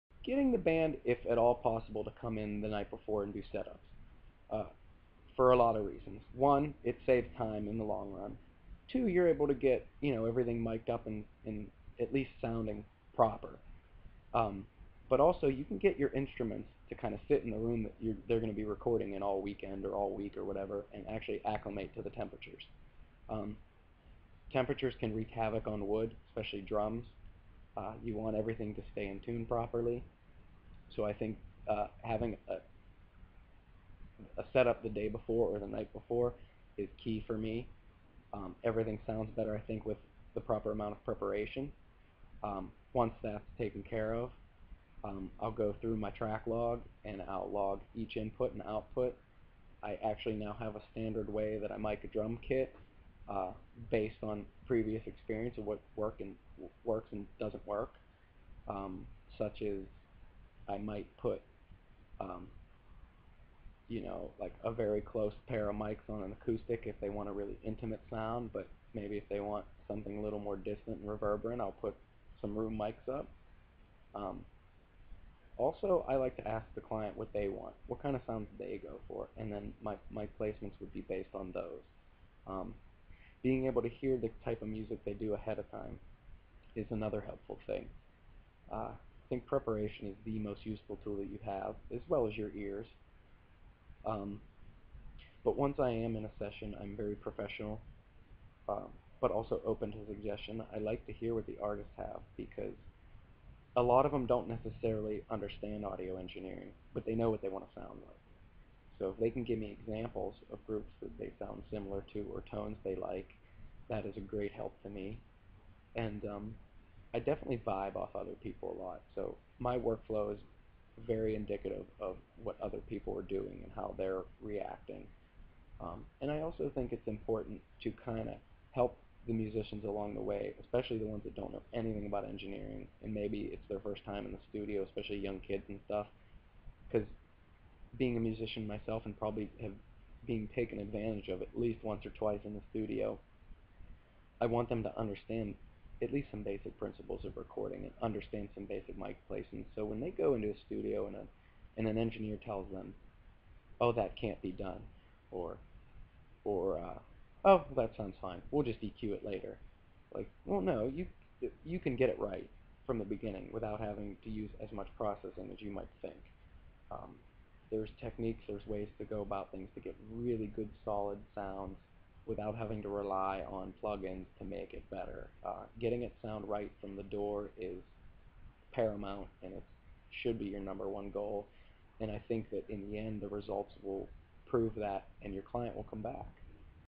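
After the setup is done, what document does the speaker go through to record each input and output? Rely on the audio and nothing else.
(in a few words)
track log.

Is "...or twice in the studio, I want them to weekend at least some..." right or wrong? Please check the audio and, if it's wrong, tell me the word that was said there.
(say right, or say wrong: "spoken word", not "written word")
wrong: "understand", not "weekend".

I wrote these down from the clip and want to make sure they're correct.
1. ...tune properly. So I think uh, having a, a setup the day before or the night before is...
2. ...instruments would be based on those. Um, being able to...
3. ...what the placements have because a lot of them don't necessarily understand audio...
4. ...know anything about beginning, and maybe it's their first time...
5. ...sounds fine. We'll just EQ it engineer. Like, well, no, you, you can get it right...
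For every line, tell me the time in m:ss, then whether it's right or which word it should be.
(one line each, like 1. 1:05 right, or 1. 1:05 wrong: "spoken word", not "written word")
1. 0:29 right
2. 1:20 wrong: "placements", not "instruments"
3. 1:41 wrong: "artists", not "placements"
4. 2:11 wrong: "engineering", not "beginning"
5. 2:37 wrong: "later", not "engineer".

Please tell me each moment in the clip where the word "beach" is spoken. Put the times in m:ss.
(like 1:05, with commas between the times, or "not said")
not said.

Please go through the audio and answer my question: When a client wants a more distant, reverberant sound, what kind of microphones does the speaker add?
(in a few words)
room mics.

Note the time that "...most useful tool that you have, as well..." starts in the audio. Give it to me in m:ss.
1:30.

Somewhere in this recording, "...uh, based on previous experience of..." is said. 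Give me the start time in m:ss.
0:53.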